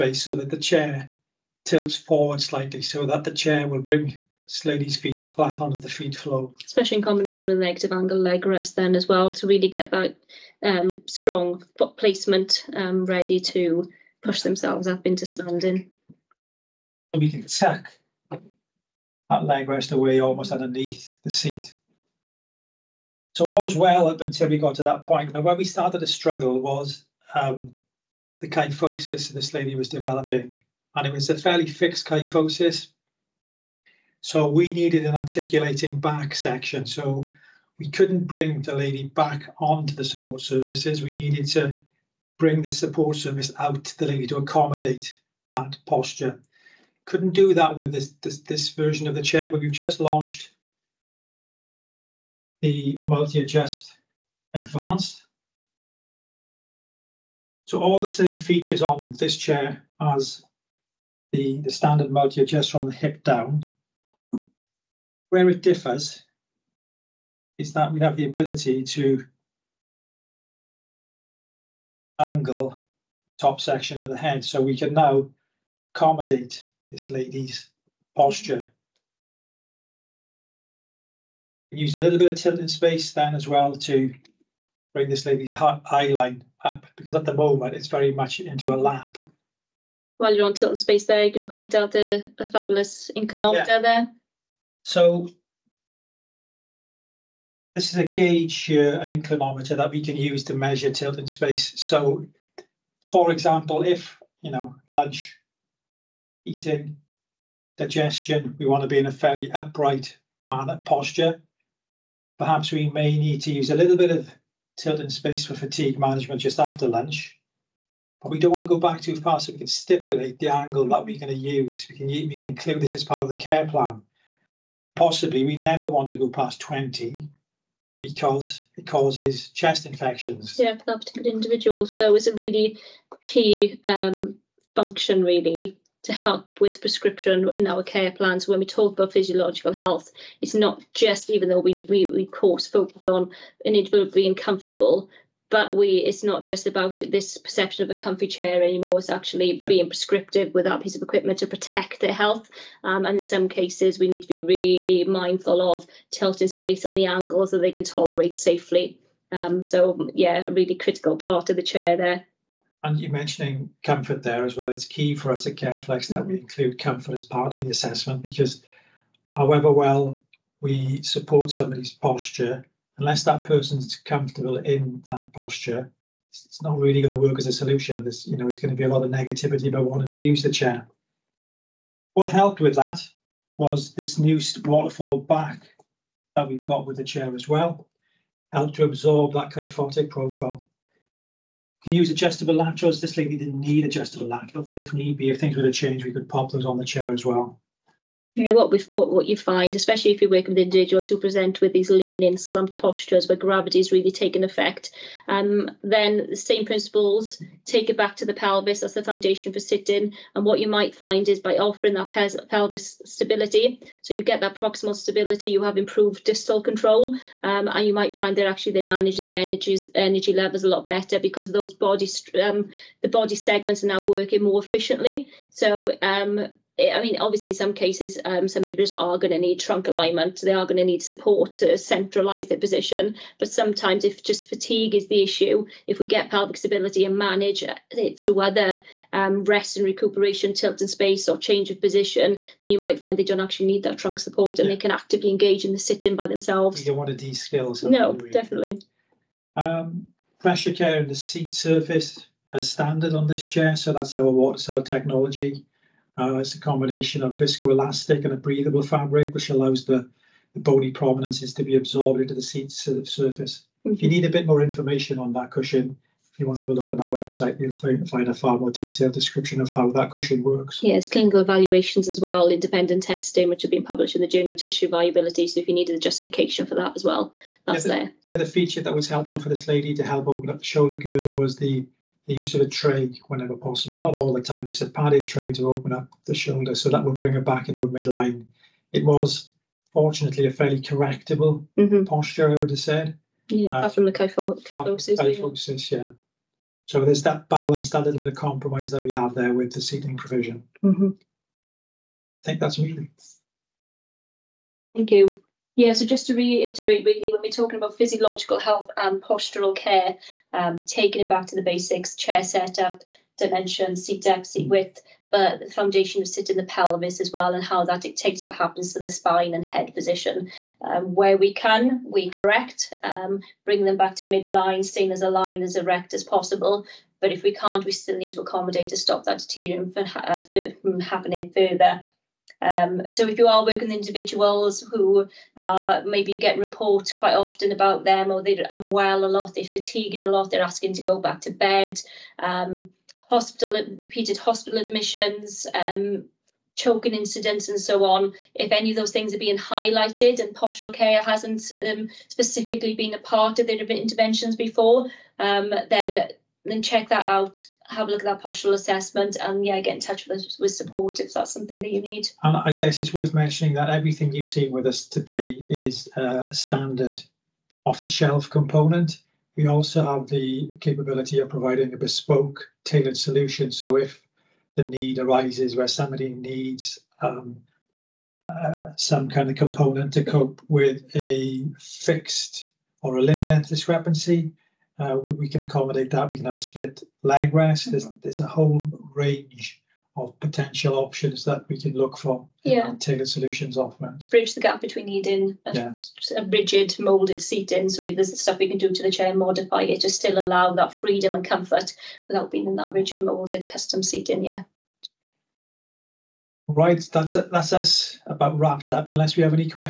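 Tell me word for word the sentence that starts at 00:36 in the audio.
So we couldn't bring the lady back onto the support surfaces.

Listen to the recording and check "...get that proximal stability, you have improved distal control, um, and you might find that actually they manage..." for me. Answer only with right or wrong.
right.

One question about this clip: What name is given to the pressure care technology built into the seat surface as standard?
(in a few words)
Water cell technology.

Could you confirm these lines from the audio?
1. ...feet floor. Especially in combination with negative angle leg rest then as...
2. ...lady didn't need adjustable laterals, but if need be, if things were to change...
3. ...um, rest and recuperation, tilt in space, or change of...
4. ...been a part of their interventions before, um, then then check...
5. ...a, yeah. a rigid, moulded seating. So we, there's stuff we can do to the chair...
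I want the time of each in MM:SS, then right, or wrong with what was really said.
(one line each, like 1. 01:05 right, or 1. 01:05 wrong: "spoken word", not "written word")
1. 00:05 right
2. 03:13 right
3. 03:59 right
4. 05:52 right
5. 06:35 right.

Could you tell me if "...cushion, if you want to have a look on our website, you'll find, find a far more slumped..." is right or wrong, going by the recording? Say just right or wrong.
wrong.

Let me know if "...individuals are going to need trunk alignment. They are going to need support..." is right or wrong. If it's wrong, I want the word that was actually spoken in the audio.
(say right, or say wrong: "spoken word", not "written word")
right.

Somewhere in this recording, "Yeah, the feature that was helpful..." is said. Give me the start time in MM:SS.
04:38.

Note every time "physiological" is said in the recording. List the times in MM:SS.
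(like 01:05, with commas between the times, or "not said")
02:19, 05:07.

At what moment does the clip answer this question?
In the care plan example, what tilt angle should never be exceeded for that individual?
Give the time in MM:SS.
02:06.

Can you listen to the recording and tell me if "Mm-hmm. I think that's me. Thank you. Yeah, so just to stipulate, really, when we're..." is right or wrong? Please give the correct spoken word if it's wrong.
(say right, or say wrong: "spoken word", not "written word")
wrong: "reiterate", not "stipulate".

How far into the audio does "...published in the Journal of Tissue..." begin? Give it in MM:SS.
04:33.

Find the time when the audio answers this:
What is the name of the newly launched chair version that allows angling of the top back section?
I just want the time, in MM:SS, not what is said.
00:53.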